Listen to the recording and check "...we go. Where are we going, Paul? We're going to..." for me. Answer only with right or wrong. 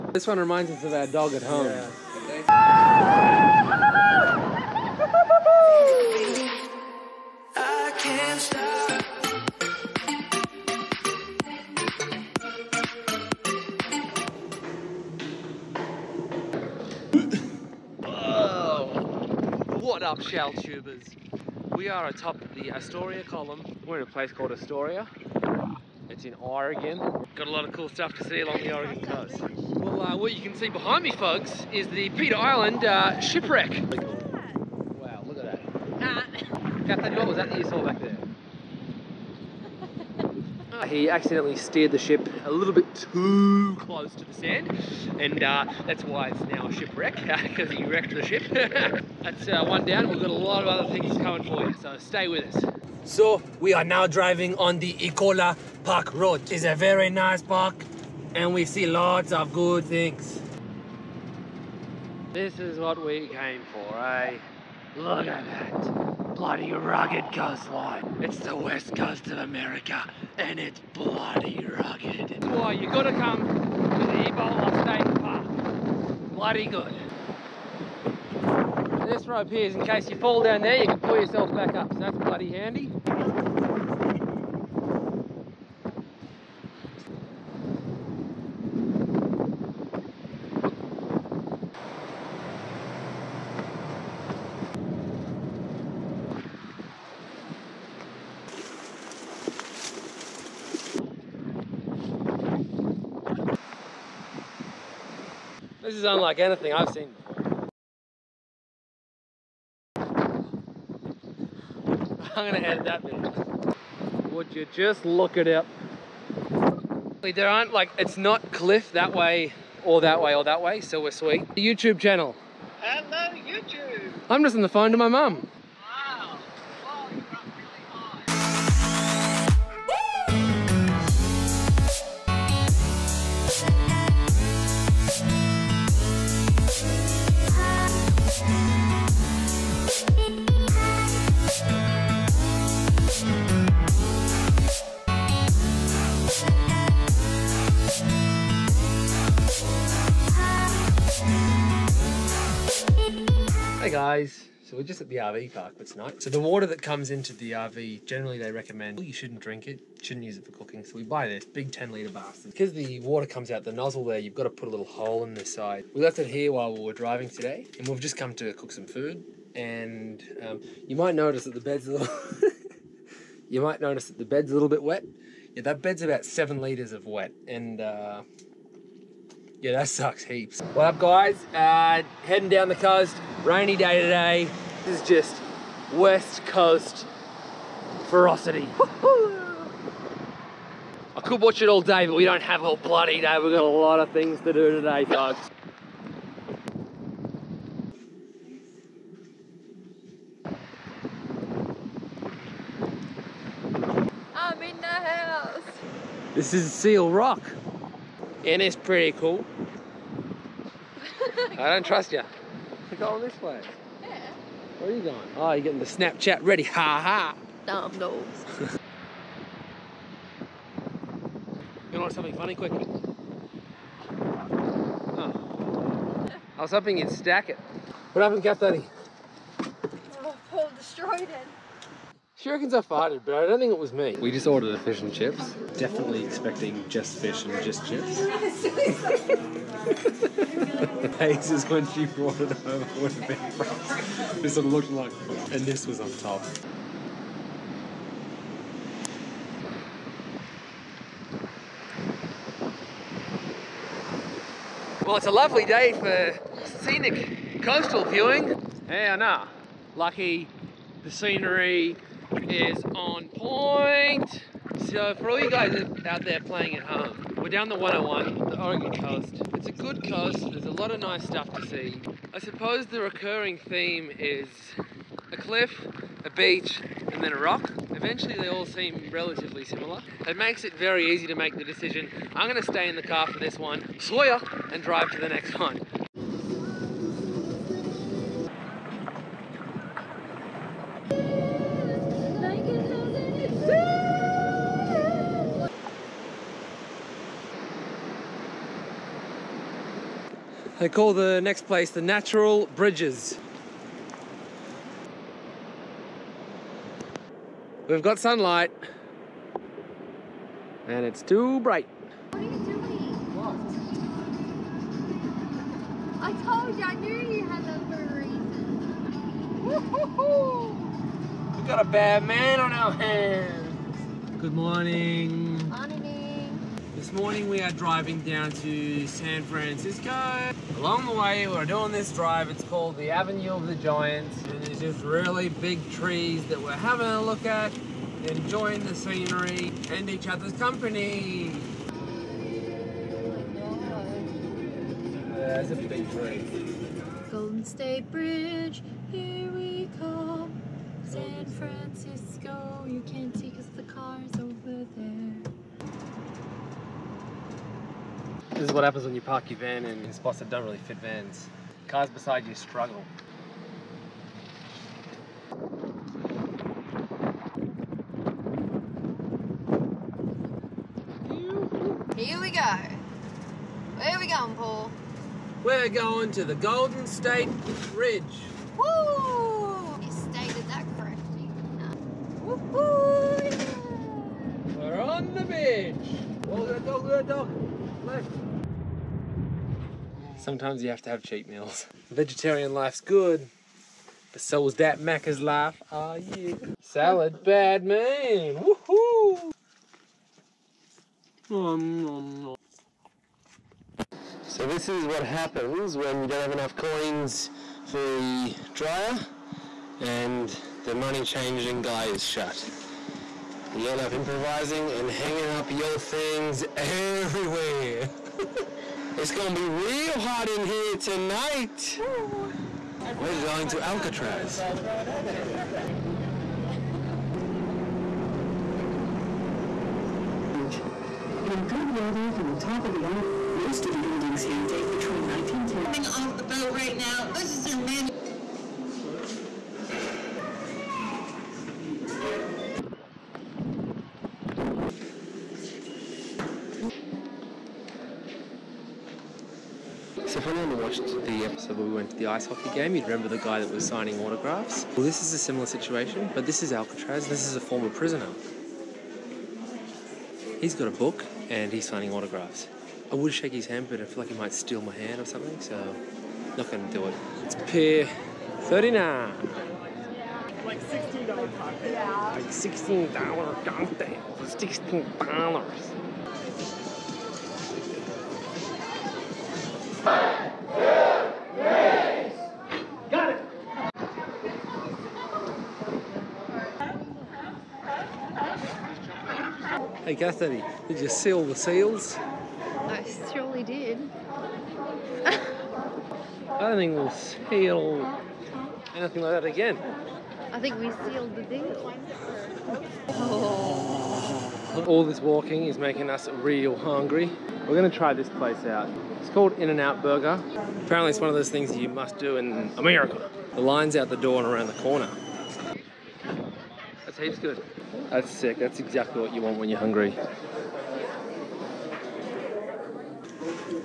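right.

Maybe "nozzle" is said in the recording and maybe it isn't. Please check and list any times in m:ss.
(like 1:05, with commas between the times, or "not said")
2:43.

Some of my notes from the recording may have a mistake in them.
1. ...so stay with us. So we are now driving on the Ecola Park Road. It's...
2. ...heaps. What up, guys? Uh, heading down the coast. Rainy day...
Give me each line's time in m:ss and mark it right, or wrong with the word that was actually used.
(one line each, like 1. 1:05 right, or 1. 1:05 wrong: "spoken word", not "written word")
1. 0:51 right
2. 3:00 right.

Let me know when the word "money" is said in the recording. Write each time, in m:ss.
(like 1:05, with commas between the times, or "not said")
6:50.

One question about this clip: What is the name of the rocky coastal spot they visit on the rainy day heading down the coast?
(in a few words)
Seal Rock.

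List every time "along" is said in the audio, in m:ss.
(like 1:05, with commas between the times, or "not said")
0:28, 5:30.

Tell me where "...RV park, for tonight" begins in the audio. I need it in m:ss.
2:35.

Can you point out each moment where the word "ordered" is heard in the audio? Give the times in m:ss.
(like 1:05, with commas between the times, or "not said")
3:54.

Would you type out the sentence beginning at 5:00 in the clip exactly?
They call the next place the Natural Bridges.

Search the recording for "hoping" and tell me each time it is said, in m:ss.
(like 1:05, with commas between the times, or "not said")
3:46.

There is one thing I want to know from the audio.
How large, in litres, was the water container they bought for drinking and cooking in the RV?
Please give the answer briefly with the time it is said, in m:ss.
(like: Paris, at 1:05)
10 litres, at 2:41.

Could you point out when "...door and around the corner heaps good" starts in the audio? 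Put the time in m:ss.
8:34.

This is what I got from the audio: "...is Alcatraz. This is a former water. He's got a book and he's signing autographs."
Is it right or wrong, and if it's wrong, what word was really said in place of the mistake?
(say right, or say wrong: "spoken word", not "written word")
wrong: "prisoner", not "water".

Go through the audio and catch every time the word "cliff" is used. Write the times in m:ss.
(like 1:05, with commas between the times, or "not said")
1:58, 4:35.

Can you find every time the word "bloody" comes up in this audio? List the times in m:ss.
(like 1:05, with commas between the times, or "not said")
1:06, 1:10, 1:16, 1:22, 3:12.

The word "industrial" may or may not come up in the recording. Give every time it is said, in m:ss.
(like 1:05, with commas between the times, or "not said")
not said.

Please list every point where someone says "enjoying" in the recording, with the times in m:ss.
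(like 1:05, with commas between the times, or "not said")
5:38.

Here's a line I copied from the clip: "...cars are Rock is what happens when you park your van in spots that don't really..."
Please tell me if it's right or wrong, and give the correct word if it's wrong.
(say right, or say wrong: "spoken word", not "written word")
wrong: "This", not "Rock".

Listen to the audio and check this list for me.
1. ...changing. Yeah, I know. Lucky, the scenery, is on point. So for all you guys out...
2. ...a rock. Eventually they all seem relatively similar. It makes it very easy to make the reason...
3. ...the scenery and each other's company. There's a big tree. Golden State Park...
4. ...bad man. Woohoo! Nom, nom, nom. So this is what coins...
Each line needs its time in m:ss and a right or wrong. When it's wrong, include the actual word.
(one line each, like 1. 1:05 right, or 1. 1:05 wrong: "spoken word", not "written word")
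1. 4:18 wrong: "viewing", not "changing"
2. 4:37 wrong: "decision", not "reason"
3. 5:38 wrong: "Bridge", not "Park"
4. 6:37 wrong: "happens", not "coins".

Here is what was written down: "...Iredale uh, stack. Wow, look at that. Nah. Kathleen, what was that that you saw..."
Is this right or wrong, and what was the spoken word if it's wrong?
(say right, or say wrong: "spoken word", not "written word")
wrong: "shipwreck", not "stack".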